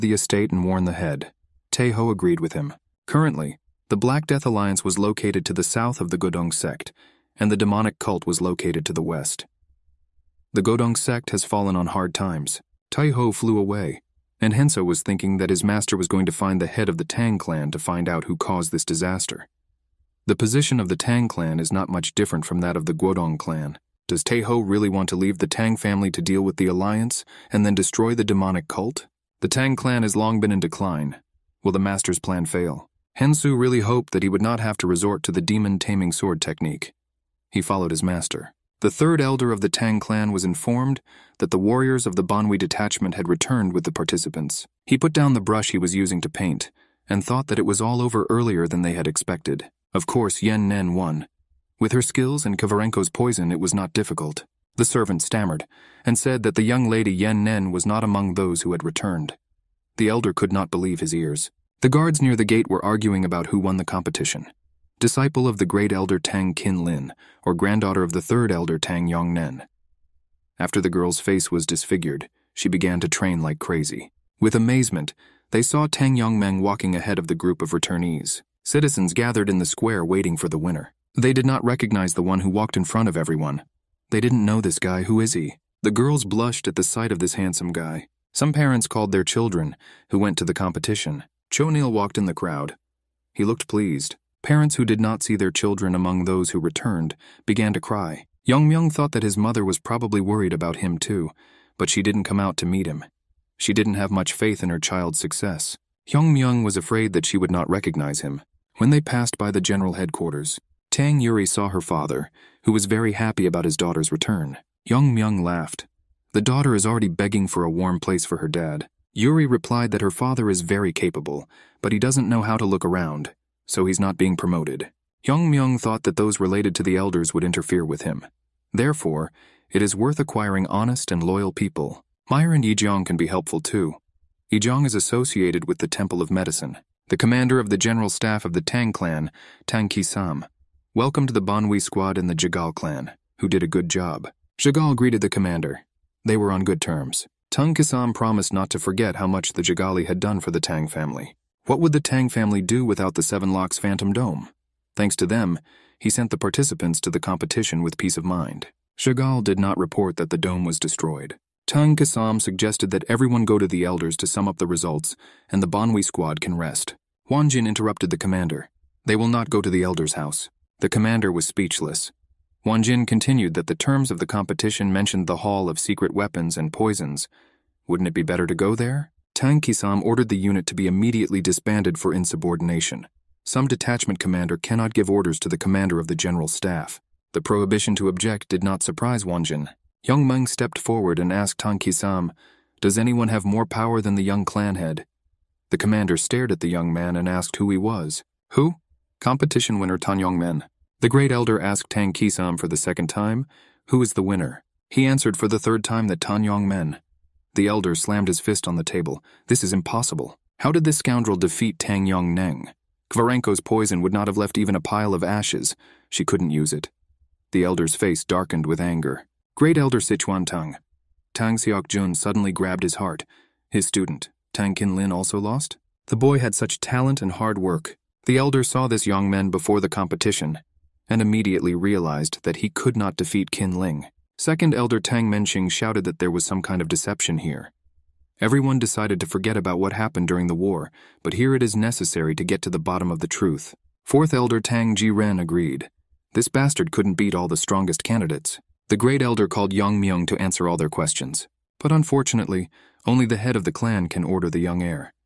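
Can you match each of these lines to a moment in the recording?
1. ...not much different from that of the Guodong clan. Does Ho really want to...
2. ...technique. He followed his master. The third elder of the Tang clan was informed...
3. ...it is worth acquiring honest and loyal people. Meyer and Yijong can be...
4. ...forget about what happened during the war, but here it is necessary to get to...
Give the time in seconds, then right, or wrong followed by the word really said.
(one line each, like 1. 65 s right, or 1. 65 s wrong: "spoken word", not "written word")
1. 21 s right
2. 36 s right
3. 129 s right
4. 239 s right.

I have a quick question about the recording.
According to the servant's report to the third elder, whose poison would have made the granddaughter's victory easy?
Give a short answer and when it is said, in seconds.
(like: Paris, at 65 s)
Kovarenko, at 52 s.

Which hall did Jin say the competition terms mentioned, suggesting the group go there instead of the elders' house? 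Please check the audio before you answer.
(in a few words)
Hall of Secret Weapons and Poisons.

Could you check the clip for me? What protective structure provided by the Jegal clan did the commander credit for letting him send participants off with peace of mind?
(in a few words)
Seven Locks Phantom Dome.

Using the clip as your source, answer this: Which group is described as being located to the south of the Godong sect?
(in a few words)
Black Death Alliance.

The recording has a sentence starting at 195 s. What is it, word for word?
The commander stared at the young man and asked who he was.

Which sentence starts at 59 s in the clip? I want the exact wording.
The elder could not believe his ears.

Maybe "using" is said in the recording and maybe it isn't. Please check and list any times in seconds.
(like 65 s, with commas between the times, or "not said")
45 s.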